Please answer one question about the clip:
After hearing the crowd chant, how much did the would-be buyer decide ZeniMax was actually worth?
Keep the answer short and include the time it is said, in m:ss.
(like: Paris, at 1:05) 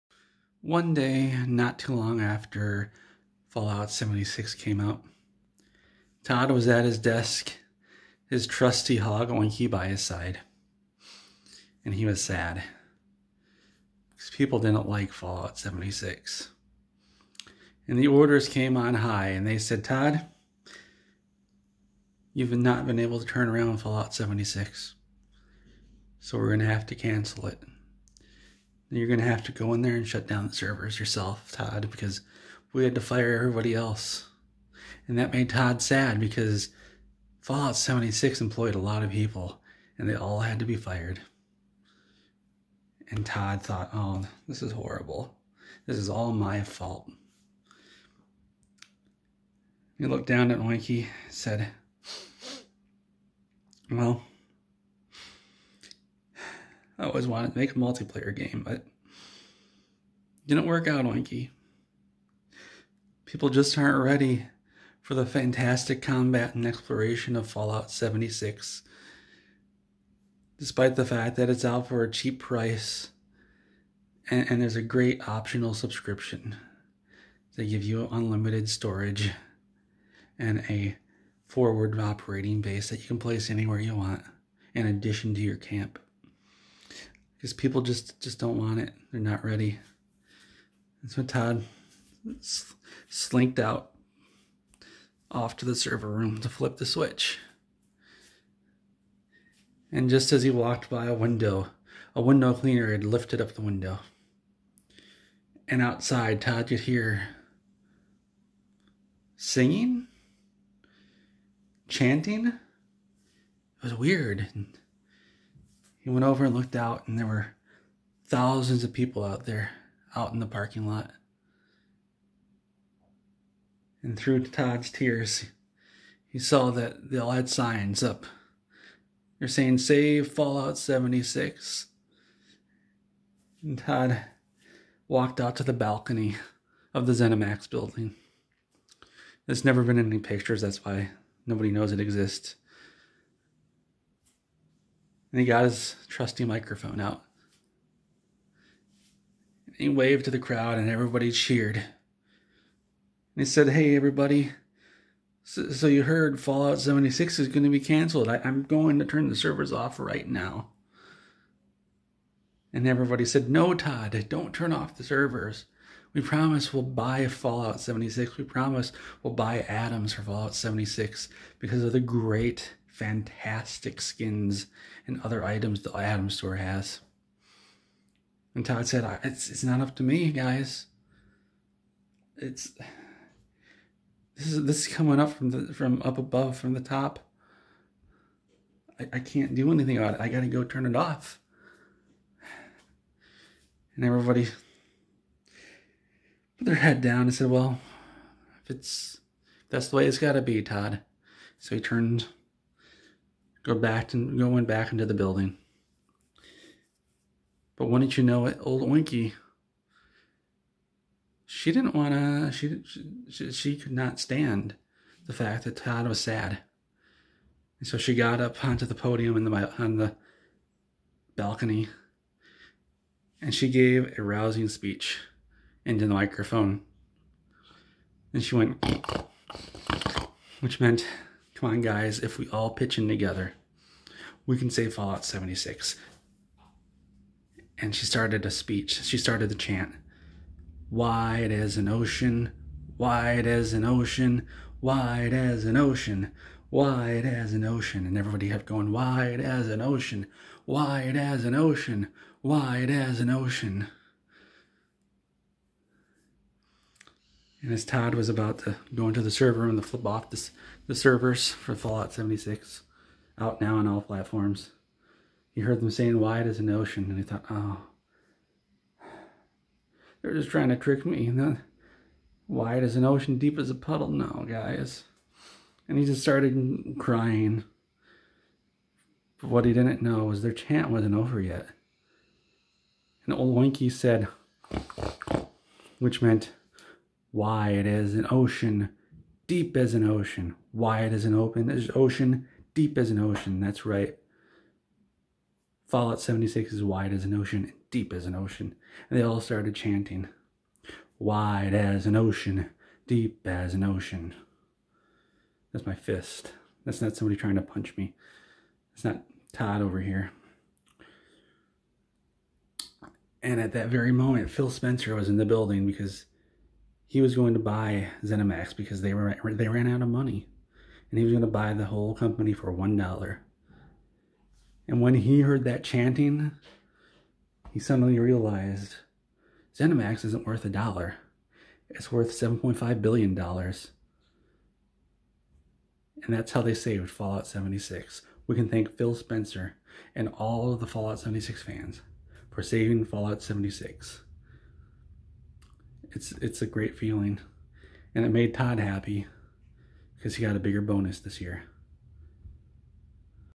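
$7.5 billion, at 5:32.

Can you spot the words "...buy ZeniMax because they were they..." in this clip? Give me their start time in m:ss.
5:17.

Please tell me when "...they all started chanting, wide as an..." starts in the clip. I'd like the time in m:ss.
4:59.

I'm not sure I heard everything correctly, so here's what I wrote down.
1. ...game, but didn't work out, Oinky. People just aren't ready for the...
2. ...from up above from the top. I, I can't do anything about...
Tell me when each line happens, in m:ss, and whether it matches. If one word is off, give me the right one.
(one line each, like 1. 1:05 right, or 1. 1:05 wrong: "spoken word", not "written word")
1. 0:58 right
2. 3:05 right.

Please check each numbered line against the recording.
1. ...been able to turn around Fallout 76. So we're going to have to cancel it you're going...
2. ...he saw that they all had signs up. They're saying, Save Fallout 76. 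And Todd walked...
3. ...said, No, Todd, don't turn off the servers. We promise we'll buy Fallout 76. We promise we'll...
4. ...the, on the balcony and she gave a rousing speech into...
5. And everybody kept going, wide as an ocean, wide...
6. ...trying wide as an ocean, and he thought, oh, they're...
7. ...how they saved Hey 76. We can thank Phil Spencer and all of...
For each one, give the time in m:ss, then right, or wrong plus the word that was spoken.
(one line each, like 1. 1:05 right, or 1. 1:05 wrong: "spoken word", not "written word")
1. 0:22 right
2. 2:06 right
3. 2:43 right
4. 3:39 right
5. 4:08 right
6. 4:25 wrong: "saying", not "trying"
7. 5:36 wrong: "Fallout", not "Hey".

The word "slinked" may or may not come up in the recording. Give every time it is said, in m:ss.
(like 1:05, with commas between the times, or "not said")
1:33.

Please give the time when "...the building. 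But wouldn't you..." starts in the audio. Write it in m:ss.
3:25.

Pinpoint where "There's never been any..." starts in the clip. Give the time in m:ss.
2:19.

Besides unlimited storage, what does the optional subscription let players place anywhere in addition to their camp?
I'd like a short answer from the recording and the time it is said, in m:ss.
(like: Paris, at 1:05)
A forward operating base, at 1:21.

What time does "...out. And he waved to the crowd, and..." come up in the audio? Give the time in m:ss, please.
2:26.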